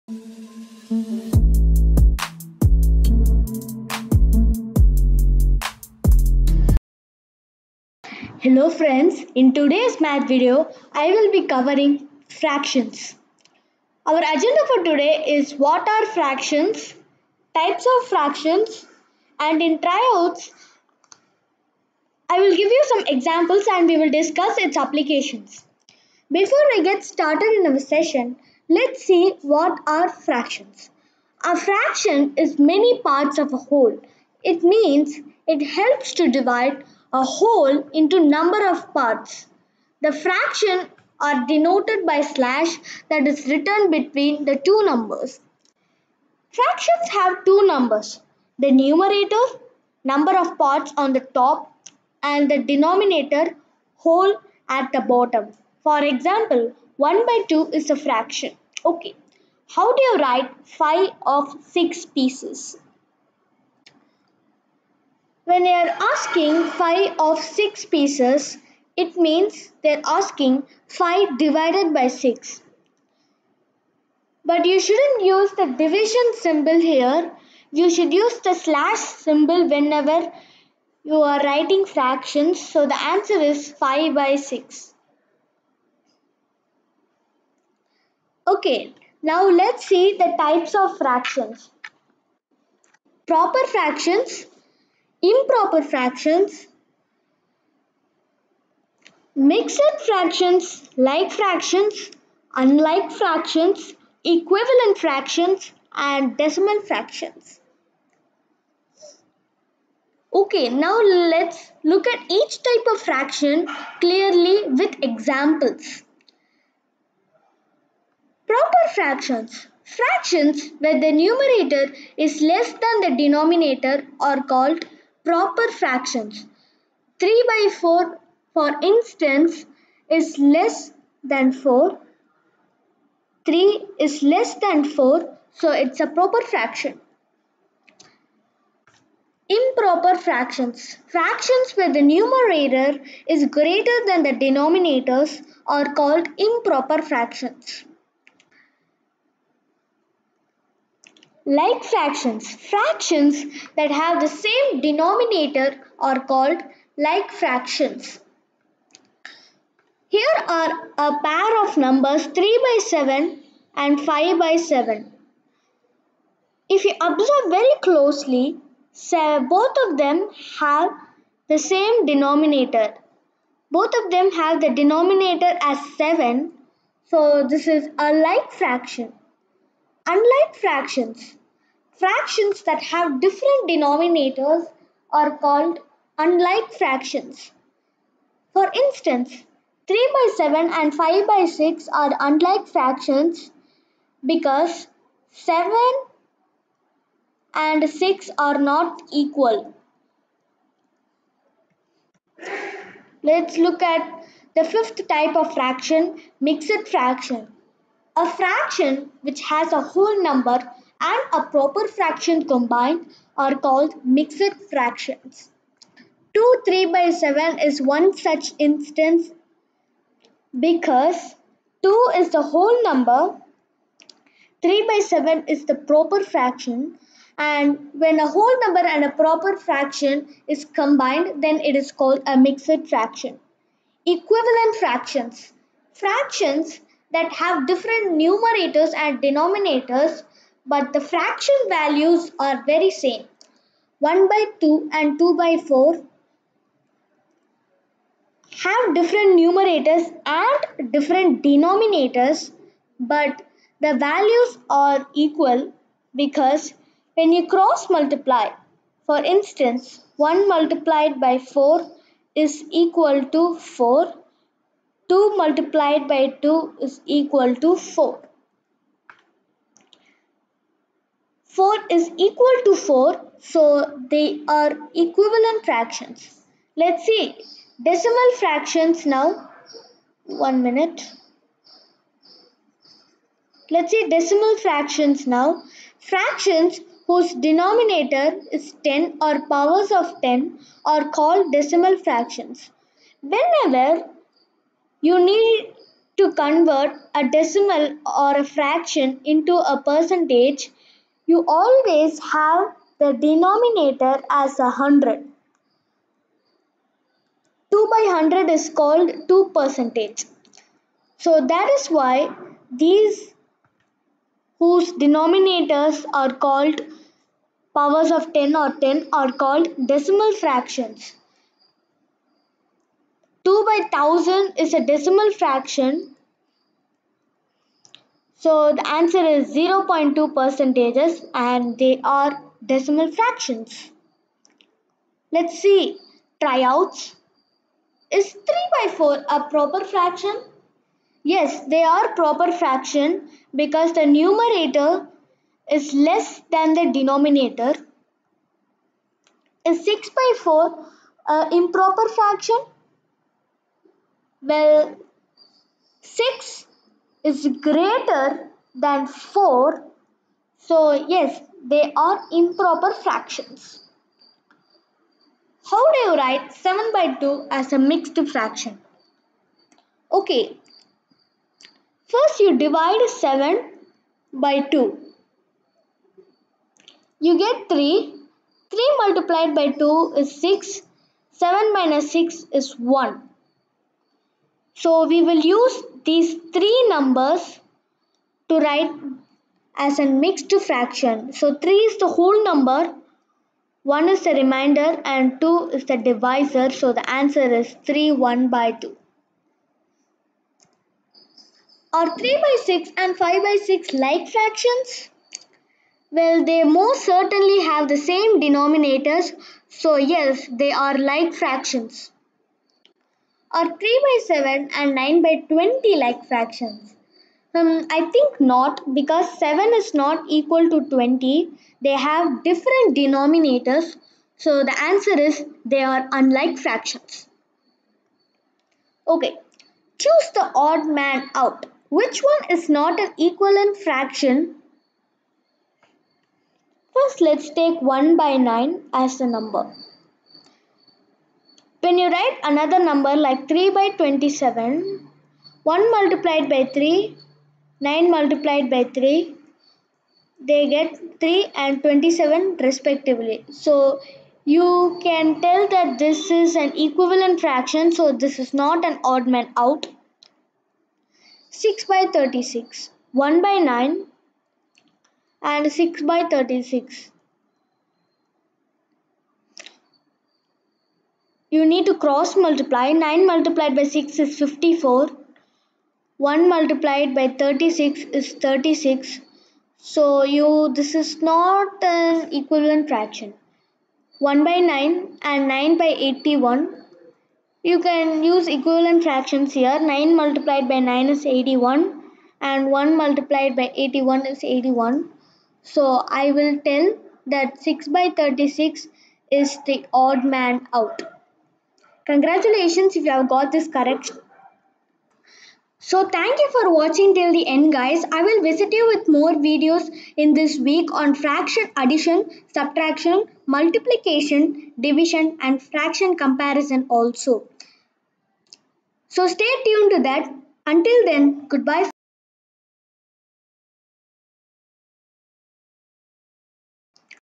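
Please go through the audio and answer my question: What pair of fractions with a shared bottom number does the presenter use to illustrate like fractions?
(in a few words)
3/7 and 5/7.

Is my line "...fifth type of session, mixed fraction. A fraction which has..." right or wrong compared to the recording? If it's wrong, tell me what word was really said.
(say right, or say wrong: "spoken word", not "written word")
wrong: "fraction", not "session".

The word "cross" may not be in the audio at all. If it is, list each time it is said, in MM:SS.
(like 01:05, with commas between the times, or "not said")
04:17, 07:52.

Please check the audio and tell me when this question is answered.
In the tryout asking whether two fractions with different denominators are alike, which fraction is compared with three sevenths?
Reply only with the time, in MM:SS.
06:54.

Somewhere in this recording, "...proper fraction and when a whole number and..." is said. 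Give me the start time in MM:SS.
03:45.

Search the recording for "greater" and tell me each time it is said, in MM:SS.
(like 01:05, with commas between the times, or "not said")
02:23, 05:57.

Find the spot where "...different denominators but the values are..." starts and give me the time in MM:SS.
04:10.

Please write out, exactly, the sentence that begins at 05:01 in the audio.
You always have the denominator as a hundred.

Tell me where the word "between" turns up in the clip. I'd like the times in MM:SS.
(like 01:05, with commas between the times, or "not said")
00:43.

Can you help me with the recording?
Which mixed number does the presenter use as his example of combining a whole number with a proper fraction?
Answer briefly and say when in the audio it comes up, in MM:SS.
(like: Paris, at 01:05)
2 3/7, at 03:36.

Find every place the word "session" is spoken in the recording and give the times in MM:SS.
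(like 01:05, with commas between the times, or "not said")
00:27.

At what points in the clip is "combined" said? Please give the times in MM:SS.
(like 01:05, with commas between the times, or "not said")
03:32, 03:50.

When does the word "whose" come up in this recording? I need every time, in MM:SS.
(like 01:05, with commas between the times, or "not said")
04:47, 05:14.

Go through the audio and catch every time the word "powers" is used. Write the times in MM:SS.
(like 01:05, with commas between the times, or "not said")
04:49, 05:17.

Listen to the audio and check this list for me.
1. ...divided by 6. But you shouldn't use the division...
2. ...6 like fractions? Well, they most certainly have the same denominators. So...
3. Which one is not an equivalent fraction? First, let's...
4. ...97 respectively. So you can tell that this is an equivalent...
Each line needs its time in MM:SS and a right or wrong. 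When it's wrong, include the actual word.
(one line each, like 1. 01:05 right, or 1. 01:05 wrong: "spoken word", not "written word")
1. 01:11 right
2. 06:43 right
3. 07:11 right
4. 07:31 wrong: "27", not "97".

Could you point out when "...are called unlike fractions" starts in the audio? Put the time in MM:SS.
03:05.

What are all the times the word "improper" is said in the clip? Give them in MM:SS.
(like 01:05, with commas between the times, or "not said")
01:35, 02:19, 02:26, 05:51, 06:02.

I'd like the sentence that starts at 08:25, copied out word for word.
So thank you for watching till the end guys.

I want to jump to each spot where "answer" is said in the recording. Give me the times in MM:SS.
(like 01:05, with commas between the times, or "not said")
01:22, 05:28, 06:37, 07:04.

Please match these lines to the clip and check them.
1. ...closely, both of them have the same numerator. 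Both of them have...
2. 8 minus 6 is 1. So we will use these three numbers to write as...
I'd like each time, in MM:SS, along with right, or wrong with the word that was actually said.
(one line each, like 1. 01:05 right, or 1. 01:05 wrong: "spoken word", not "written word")
1. 02:47 wrong: "denominator", not "numerator"
2. 06:21 wrong: "7", not "8".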